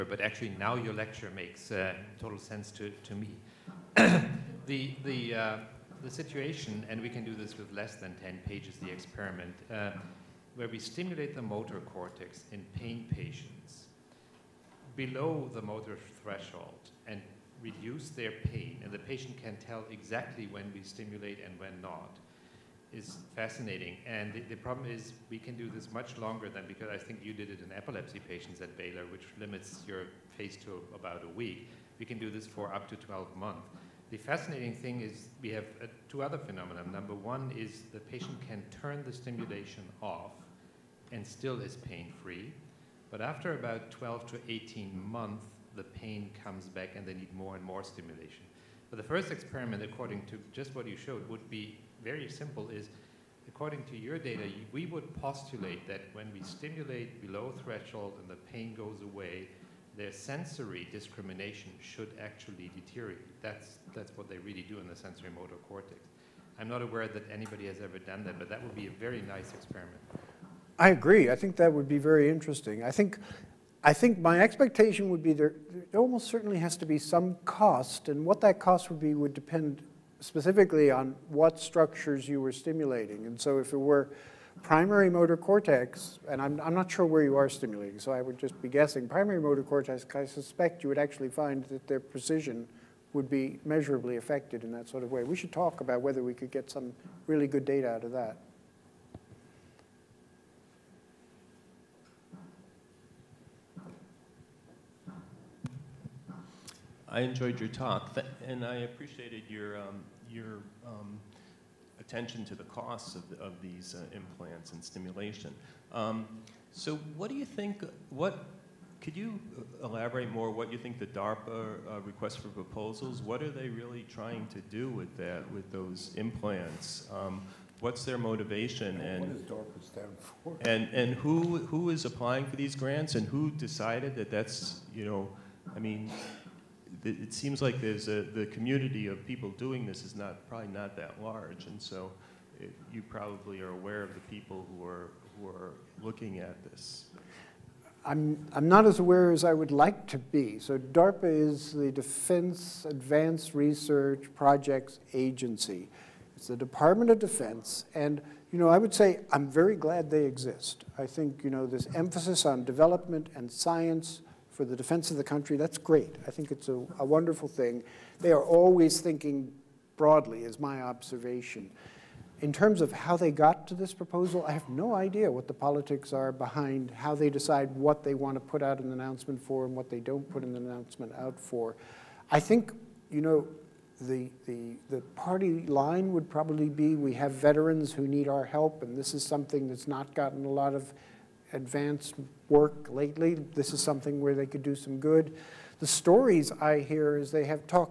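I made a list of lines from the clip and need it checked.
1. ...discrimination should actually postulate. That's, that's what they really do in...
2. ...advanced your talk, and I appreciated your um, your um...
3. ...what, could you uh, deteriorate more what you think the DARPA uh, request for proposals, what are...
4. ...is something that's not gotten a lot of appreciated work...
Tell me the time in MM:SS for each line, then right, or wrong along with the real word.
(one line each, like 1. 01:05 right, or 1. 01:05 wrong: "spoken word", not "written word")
1. 01:00 wrong: "deteriorate", not "postulate"
2. 01:47 wrong: "enjoyed", not "advanced"
3. 01:58 wrong: "elaborate", not "deteriorate"
4. 03:09 wrong: "advanced", not "appreciated".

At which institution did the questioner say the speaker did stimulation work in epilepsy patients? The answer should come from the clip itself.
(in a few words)
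Baylor.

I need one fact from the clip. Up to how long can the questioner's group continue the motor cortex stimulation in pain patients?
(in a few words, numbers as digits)
12 months.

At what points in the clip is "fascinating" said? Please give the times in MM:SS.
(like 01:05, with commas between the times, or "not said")
00:23, 00:34.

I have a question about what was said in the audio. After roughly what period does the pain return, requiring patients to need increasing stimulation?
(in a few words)
12 to 18 months.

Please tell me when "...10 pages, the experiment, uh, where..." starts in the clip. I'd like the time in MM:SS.
00:08.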